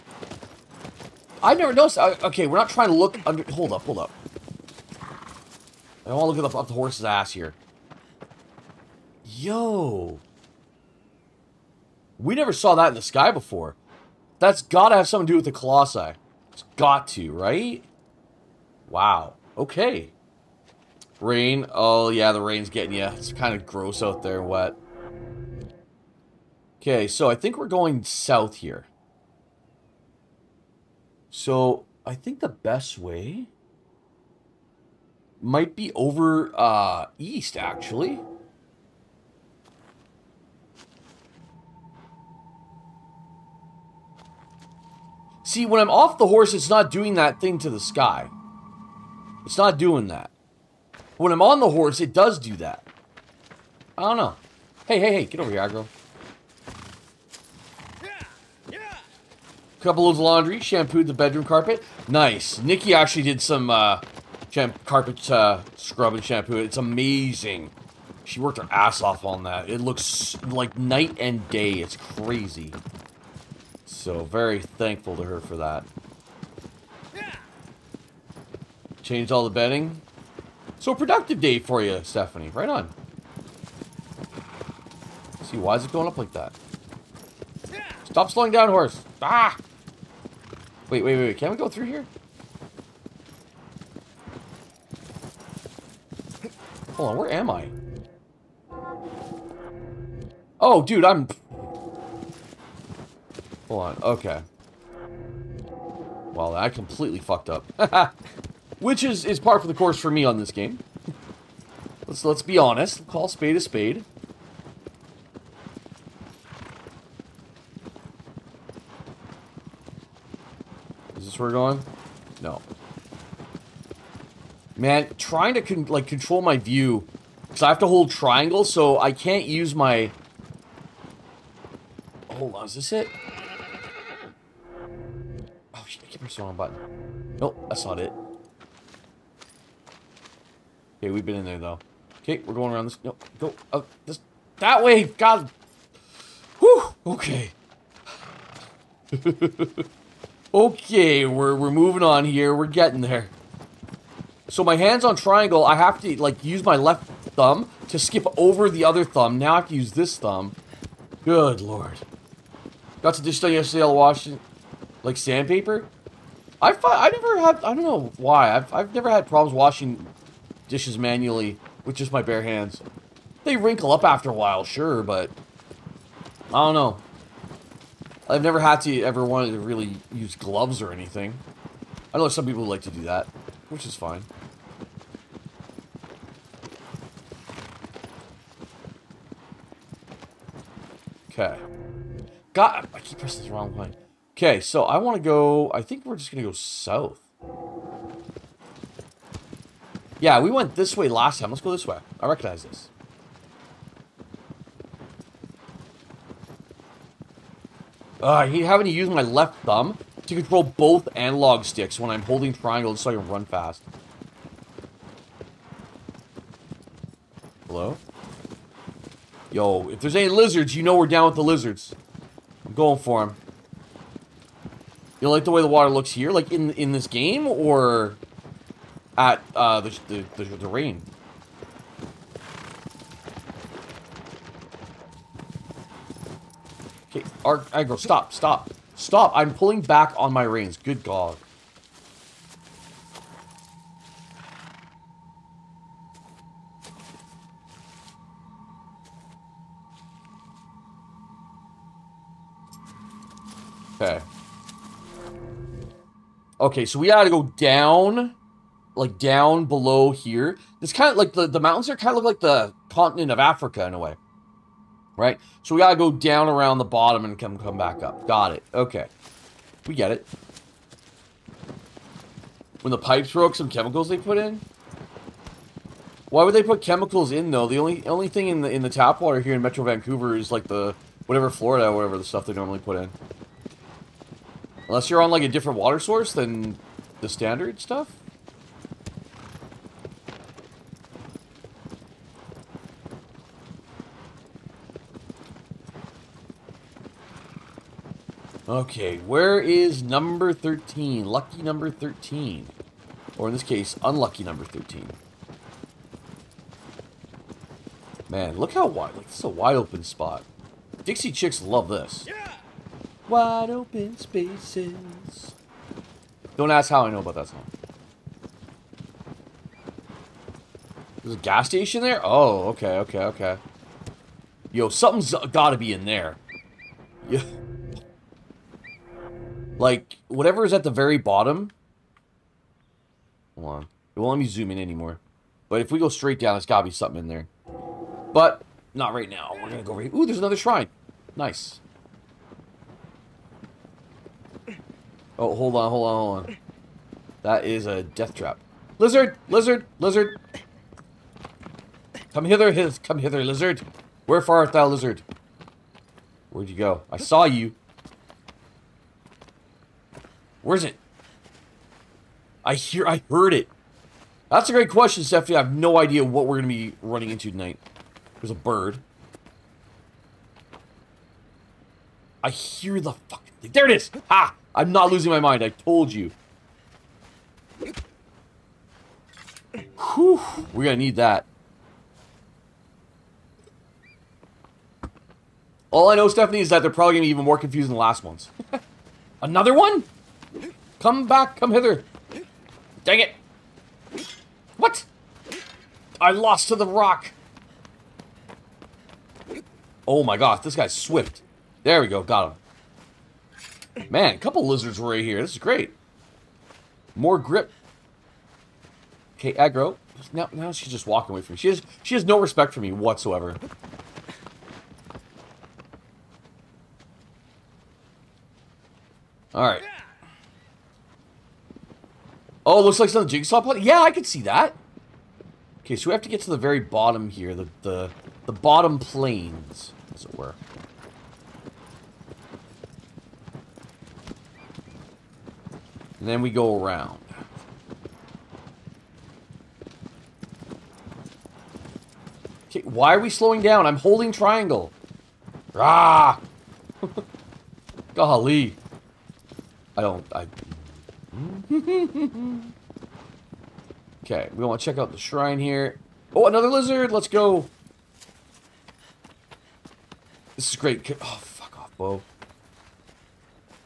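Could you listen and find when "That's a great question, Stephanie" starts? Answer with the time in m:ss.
6:04.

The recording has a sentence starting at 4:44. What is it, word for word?
Unless you're on, like, a different water source than the standard stuff?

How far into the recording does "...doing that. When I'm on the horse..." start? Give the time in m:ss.
0:49.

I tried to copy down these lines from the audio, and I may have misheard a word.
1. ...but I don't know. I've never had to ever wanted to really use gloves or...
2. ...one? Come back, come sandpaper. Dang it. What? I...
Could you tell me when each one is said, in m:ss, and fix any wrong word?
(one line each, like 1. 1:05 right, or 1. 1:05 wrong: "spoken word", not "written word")
1. 2:55 right
2. 6:29 wrong: "hither", not "sandpaper".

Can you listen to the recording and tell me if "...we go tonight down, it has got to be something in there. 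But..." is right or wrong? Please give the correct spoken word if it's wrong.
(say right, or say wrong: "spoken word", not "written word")
wrong: "straight", not "tonight".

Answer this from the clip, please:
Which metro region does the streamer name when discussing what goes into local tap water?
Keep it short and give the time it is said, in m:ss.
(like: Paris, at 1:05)
Metro Vancouver, at 4:39.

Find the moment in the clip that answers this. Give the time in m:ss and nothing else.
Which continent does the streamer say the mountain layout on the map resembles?
4:23.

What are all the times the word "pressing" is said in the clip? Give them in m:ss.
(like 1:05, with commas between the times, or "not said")
2:16, 3:13.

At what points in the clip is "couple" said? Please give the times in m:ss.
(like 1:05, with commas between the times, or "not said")
0:59, 6:44.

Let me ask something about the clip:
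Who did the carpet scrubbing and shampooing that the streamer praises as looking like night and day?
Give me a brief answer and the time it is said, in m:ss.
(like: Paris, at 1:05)
Nikki, at 1:02.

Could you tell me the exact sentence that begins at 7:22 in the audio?
Okay, why are we slowing down?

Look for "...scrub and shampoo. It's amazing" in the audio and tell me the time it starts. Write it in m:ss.
1:05.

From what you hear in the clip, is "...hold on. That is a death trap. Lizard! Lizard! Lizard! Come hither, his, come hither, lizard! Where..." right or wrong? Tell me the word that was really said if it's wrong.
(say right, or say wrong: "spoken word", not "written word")
right.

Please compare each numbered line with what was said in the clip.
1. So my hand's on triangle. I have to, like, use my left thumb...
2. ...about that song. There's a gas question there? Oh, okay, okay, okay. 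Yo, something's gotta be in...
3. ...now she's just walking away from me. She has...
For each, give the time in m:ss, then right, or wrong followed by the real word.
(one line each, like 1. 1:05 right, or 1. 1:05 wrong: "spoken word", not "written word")
1. 2:34 right
2. 5:17 wrong: "station", not "question"
3. 6:50 right.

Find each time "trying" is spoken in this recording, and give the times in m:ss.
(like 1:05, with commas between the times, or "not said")
0:02, 2:05.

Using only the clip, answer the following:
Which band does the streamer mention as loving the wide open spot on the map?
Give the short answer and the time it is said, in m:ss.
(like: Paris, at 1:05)
Dixie Chicks, at 5:11.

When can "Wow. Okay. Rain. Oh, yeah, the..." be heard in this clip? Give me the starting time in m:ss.
0:18.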